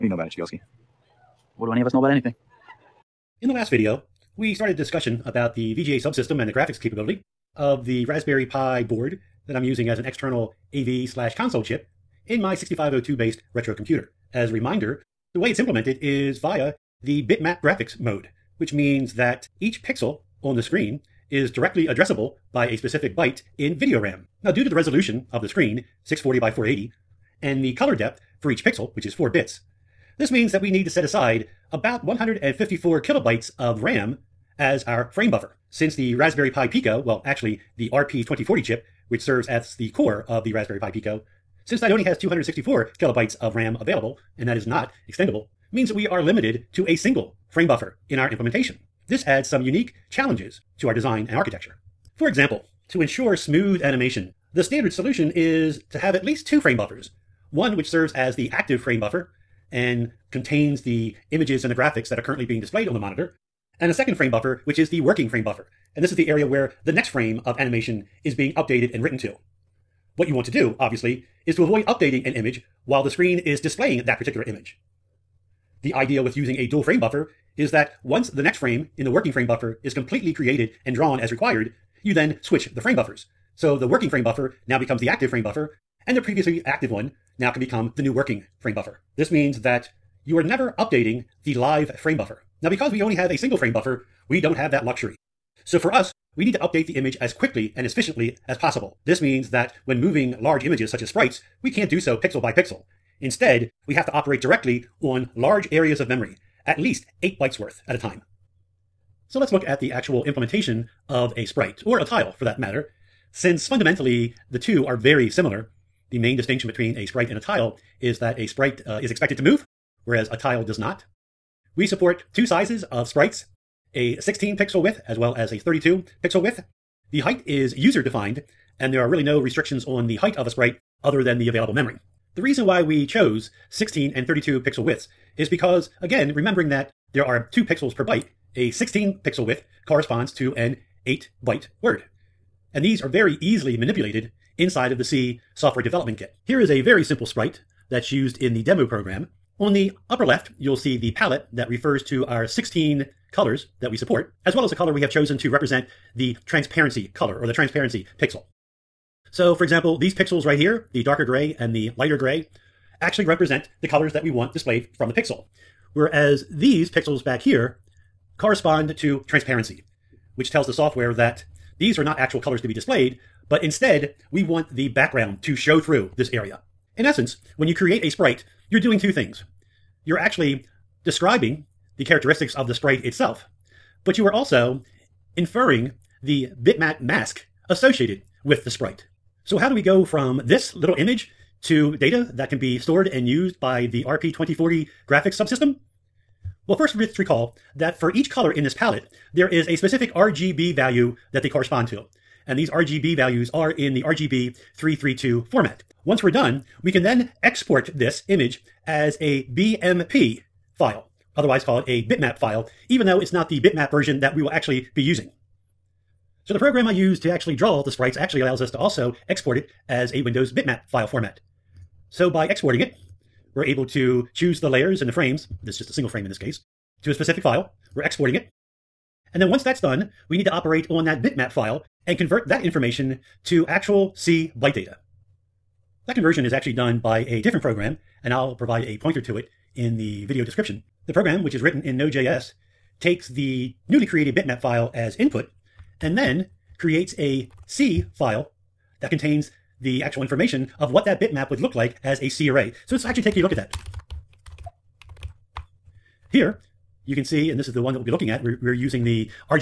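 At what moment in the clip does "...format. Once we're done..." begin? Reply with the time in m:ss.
3:25.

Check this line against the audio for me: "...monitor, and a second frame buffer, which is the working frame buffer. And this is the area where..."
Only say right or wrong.
right.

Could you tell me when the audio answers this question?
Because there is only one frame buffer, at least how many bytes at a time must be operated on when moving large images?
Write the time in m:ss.
1:47.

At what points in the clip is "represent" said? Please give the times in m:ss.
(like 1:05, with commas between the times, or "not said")
2:35, 2:43.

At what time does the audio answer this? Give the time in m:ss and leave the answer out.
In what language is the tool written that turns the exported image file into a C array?
4:01.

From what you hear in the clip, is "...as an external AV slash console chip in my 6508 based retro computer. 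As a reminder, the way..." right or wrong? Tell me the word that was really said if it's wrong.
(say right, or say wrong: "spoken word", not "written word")
wrong: "6502", not "6508".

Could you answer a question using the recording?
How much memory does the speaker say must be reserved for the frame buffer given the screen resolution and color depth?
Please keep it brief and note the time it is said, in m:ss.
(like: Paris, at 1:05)
154 kilobytes, at 0:32.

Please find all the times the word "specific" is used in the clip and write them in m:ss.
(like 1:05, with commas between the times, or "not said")
0:22, 3:19, 3:47.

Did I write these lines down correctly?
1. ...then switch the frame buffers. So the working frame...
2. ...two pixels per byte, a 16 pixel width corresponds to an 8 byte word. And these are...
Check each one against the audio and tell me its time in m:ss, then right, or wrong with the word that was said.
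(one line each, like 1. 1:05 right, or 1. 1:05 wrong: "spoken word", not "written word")
1. 1:22 right
2. 2:17 right.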